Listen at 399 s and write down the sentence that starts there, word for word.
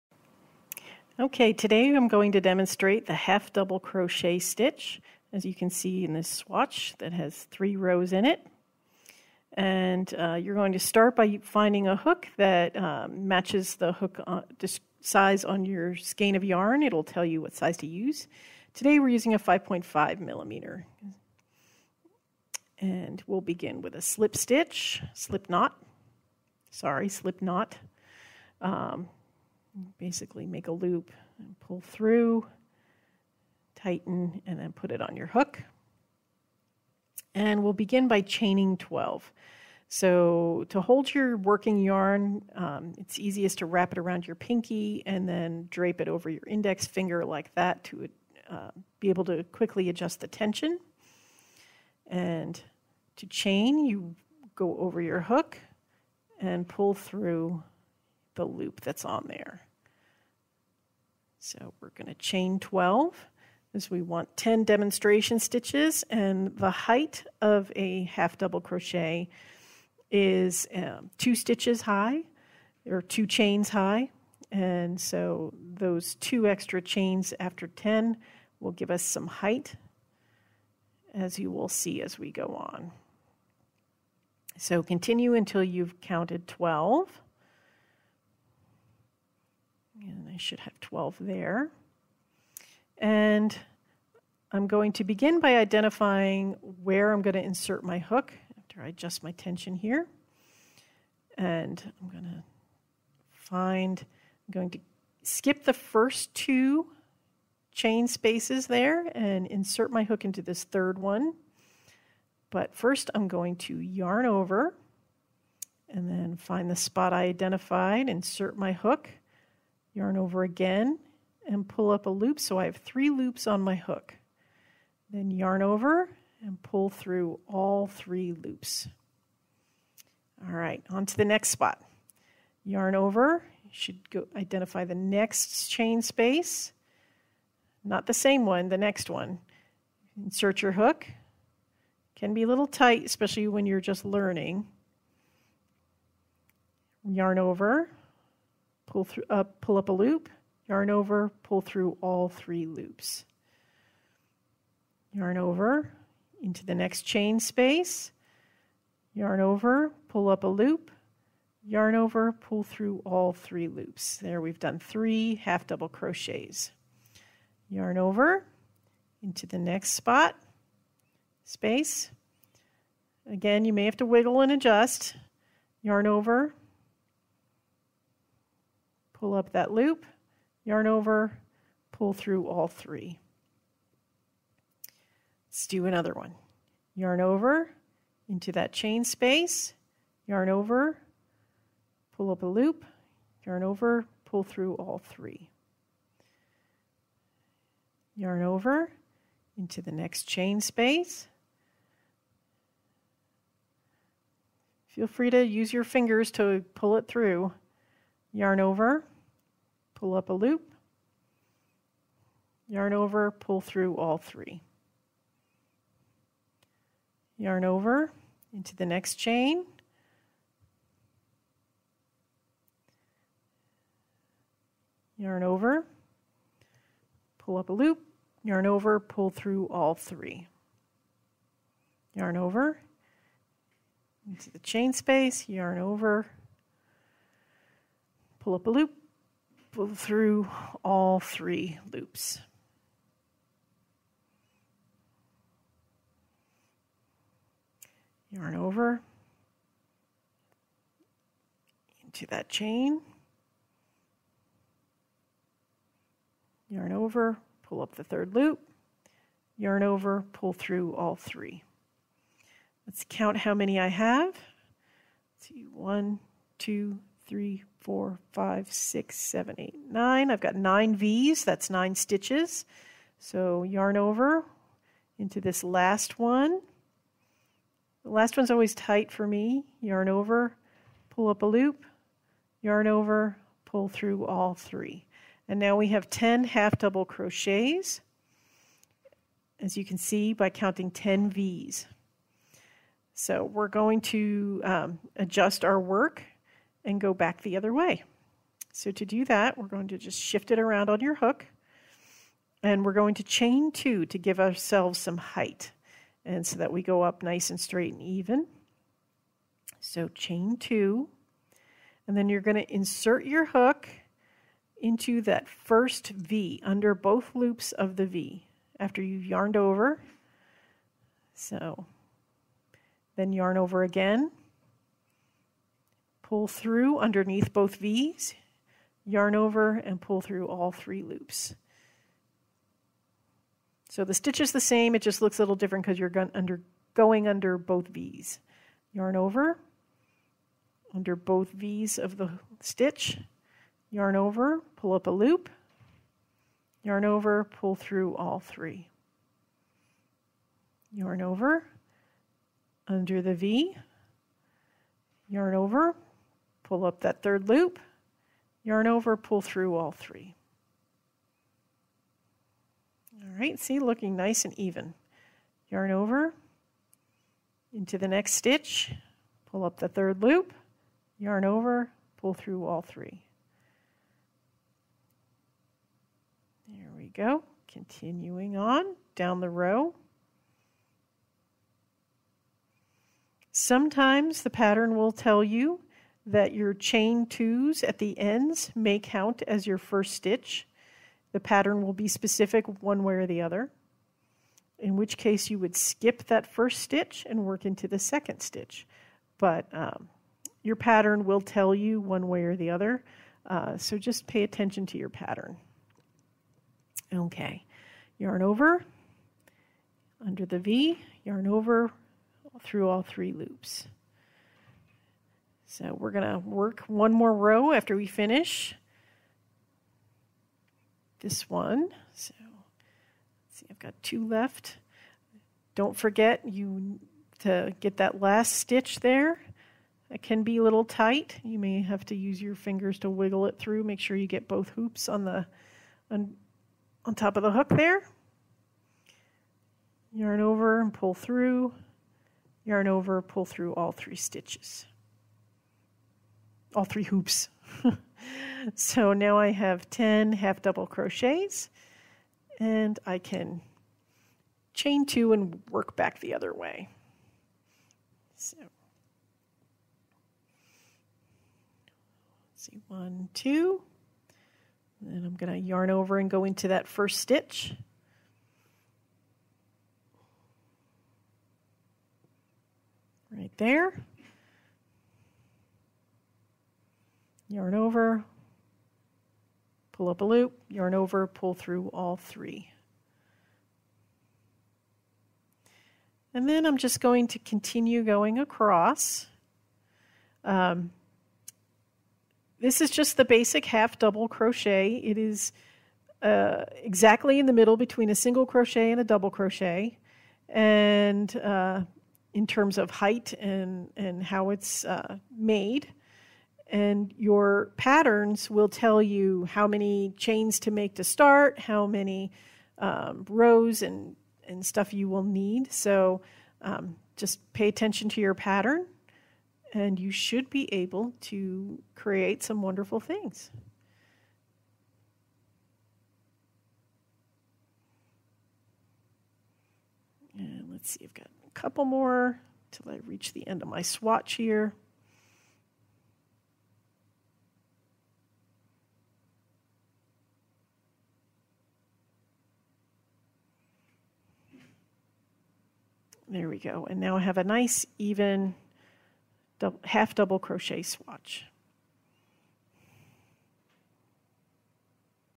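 But um, your pattern will tell you one way or the other, uh, so just pay attention to your pattern.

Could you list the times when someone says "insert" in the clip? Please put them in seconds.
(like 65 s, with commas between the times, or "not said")
97 s, 109 s, 118 s, 140 s, 312 s.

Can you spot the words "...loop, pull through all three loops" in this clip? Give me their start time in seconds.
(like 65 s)
238 s.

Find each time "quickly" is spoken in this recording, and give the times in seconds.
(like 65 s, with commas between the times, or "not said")
49 s.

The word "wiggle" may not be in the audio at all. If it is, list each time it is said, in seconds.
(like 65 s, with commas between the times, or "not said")
174 s, 433 s.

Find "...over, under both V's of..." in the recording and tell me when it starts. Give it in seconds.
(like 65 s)
339 s.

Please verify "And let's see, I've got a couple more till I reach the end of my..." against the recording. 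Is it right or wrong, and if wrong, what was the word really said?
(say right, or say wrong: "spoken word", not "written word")
right.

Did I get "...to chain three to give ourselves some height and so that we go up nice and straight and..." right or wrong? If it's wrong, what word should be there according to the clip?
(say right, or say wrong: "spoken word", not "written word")
wrong: "two", not "three".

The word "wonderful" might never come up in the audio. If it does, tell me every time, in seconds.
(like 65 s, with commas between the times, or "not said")
522 s.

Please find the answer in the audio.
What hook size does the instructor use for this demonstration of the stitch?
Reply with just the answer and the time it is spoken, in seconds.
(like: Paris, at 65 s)
5.5 millimeter, at 19 s.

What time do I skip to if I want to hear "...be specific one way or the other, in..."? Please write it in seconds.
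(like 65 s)
391 s.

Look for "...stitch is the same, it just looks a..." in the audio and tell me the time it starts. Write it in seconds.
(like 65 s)
334 s.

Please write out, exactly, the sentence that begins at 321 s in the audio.
So then yarn over again pull through underneath both V's, yarn over and pull through all three loops.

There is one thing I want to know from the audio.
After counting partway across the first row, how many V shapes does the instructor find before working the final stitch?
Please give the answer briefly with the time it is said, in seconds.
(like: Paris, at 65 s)
9, at 270 s.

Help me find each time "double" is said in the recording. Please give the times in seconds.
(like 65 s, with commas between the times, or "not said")
3 s, 68 s, 165 s, 286 s, 450 s, 493 s, 499 s, 550 s.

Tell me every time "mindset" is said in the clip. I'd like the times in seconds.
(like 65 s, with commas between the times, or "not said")
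not said.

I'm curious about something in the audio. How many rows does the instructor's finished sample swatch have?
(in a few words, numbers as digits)
3.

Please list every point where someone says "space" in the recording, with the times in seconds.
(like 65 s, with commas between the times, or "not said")
108 s, 136 s, 157 s, 171 s, 189 s, 200 s, 234 s.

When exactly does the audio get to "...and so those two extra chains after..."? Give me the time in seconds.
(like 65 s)
74 s.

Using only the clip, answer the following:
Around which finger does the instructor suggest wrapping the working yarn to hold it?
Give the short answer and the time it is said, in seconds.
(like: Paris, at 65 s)
pinky, at 44 s.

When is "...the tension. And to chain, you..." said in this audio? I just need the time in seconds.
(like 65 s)
50 s.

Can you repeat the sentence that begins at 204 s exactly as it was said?
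Feel free to use your fingers to pull it through yarn over, pull up a loop, yarn over, pull through all three.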